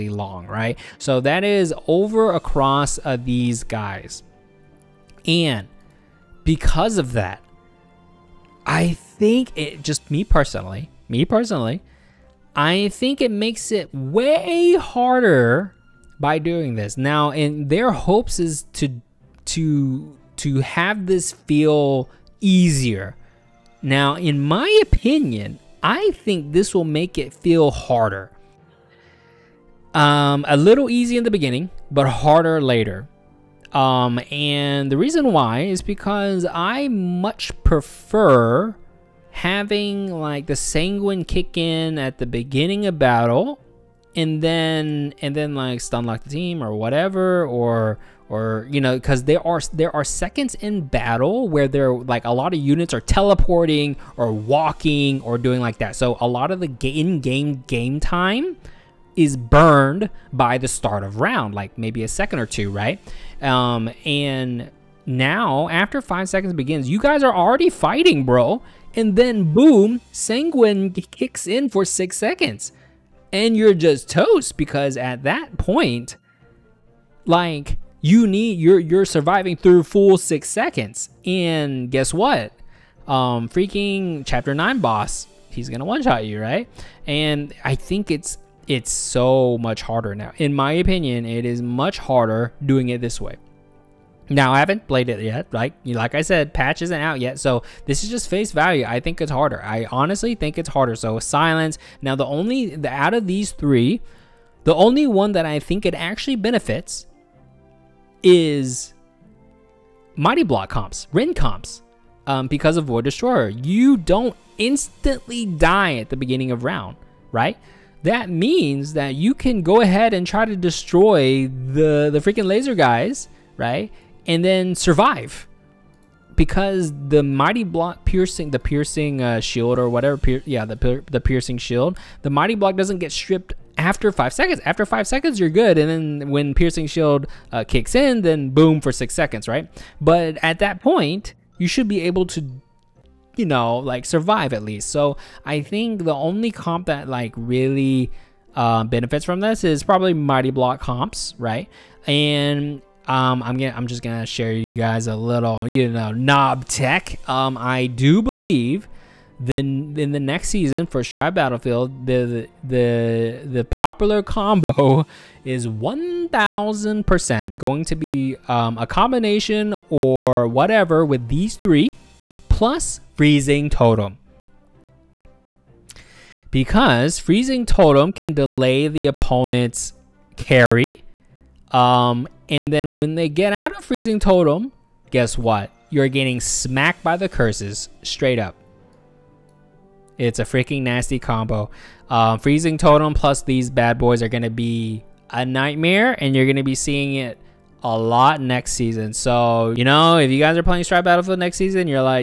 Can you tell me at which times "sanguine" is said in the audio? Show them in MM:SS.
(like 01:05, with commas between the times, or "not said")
00:40, 01:10.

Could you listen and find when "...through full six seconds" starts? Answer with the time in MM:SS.
01:19.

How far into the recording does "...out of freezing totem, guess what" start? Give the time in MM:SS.
03:03.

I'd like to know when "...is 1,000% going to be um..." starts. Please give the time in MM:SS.
02:45.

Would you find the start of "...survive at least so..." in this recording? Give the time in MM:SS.
02:24.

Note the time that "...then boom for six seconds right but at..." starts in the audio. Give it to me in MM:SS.
02:18.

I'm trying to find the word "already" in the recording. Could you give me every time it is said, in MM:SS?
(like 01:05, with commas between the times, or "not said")
01:07.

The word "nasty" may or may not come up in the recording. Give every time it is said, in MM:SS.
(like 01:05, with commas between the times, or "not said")
03:10.